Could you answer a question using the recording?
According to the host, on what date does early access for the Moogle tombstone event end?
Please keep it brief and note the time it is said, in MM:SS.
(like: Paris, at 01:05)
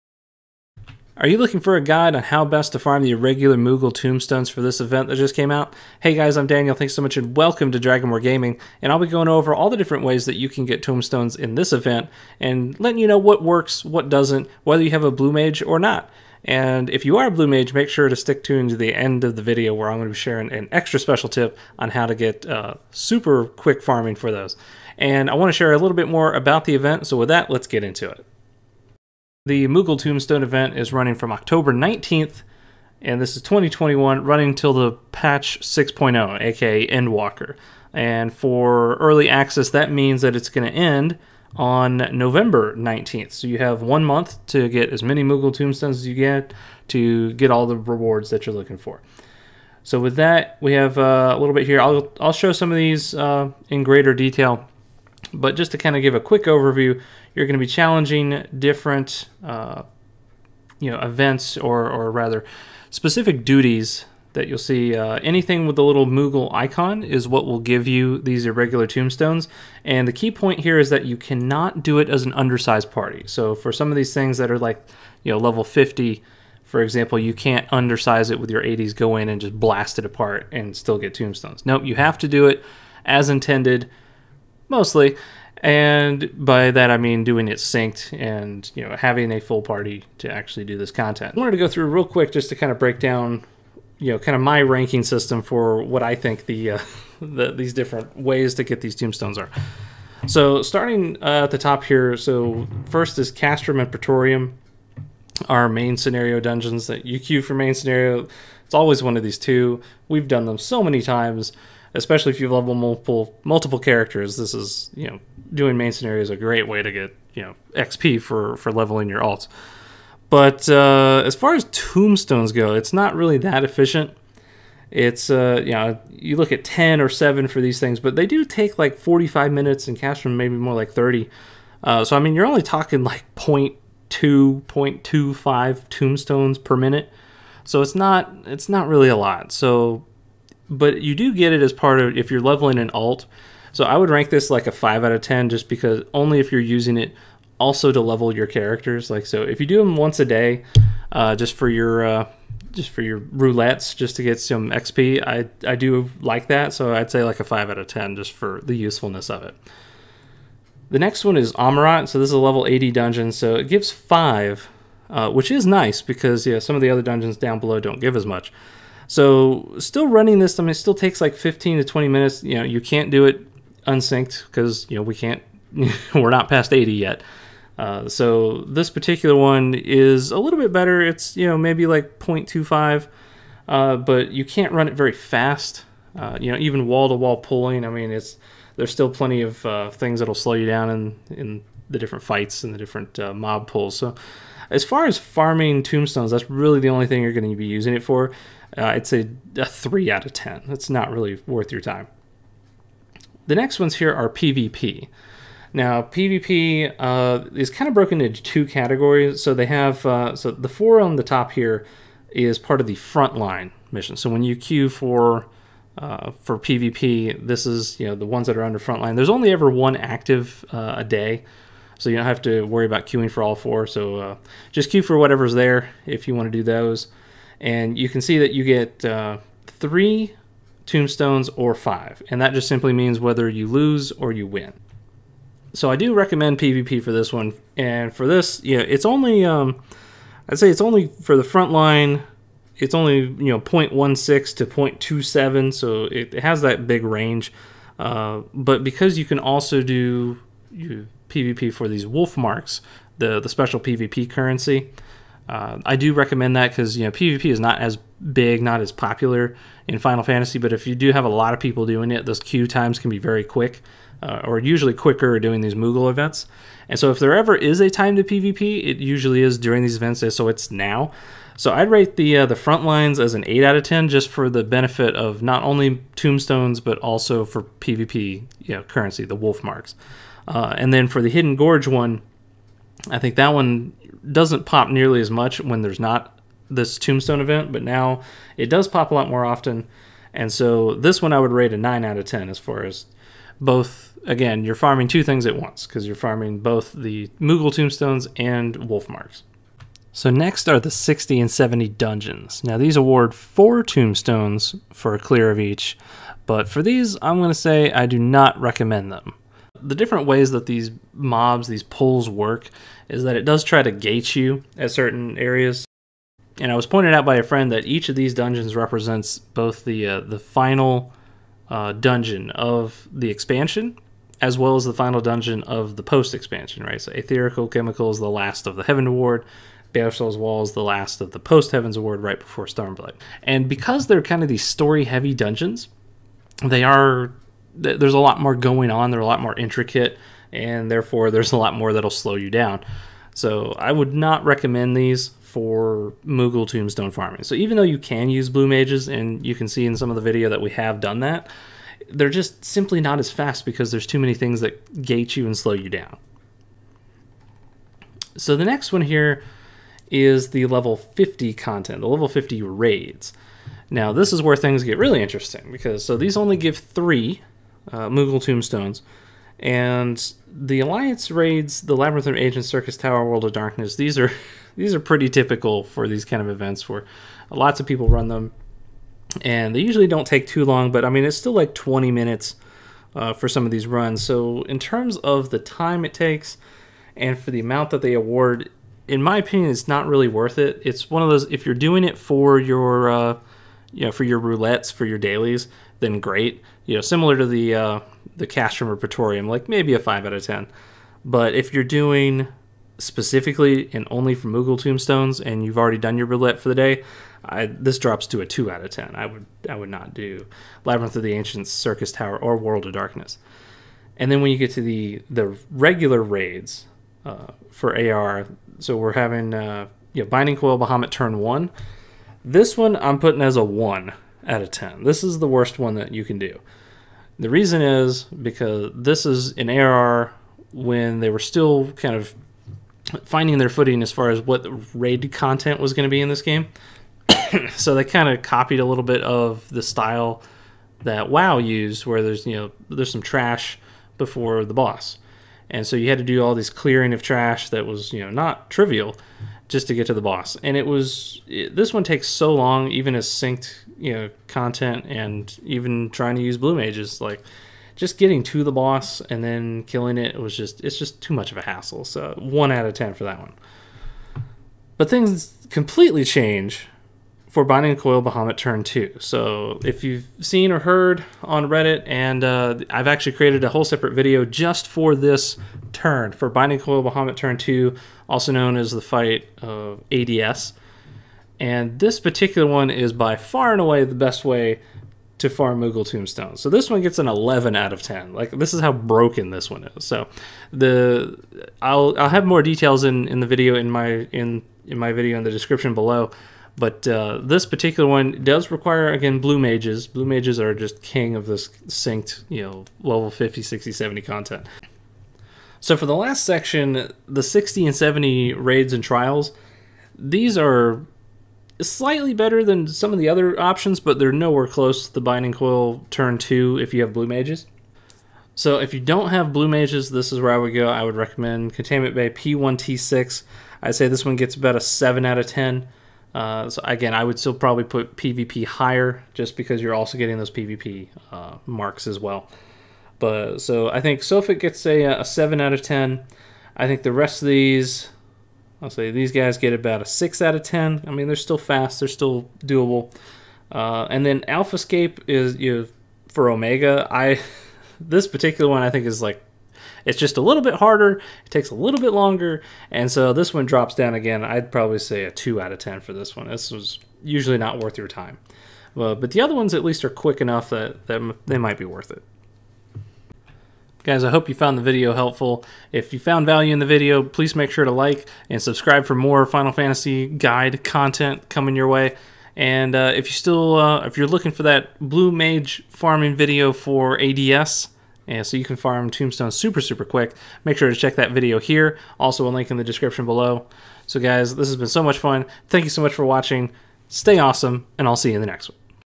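November 19th, at 00:42.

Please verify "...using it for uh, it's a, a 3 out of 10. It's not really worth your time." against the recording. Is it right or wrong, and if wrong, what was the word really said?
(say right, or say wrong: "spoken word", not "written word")
right.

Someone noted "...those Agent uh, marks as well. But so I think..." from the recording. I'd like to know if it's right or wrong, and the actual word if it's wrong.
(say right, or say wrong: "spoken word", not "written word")
wrong: "PvP", not "Agent".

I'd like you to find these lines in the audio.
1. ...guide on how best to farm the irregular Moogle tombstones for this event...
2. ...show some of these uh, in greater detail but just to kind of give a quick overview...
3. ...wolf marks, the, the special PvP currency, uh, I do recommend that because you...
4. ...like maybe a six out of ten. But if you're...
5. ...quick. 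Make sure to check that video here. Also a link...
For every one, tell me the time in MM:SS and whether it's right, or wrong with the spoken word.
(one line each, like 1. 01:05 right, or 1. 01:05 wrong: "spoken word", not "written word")
1. 00:01 right
2. 00:52 right
3. 04:12 right
4. 06:39 wrong: "five", not "six"
5. 09:40 right.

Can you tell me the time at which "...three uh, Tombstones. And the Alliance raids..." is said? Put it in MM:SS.
06:06.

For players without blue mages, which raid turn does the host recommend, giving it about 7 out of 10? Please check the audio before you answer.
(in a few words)
Containment Bay P1T6.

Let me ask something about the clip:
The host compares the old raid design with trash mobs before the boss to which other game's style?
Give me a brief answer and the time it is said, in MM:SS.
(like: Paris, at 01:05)
WoW, at 07:21.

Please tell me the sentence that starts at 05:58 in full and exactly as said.
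So the next one here is the level 50 content, the level 50 raids.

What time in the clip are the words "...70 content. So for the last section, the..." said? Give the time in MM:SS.
08:23.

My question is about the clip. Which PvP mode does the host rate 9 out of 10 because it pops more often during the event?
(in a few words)
Hidden Gorge.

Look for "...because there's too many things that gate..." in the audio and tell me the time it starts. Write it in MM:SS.
05:53.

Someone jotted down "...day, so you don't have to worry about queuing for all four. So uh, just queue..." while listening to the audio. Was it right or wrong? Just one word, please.
right.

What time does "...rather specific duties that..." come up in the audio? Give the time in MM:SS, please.
01:02.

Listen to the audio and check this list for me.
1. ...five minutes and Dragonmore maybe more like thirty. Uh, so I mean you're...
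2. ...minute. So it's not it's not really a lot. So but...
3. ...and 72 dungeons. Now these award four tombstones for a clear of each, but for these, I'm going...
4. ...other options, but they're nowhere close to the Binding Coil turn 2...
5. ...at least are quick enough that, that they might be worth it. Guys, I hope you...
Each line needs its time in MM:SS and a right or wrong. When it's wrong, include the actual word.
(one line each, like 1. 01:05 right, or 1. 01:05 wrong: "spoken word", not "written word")
1. 02:09 wrong: "Castrum", not "Dragonmore"
2. 02:16 right
3. 05:01 wrong: "70", not "72"
4. 08:33 right
5. 09:19 right.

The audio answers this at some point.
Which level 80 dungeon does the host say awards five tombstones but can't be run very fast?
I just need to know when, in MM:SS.
02:41.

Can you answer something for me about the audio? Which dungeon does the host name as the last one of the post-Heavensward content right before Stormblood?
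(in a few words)
Baelsar's Wall.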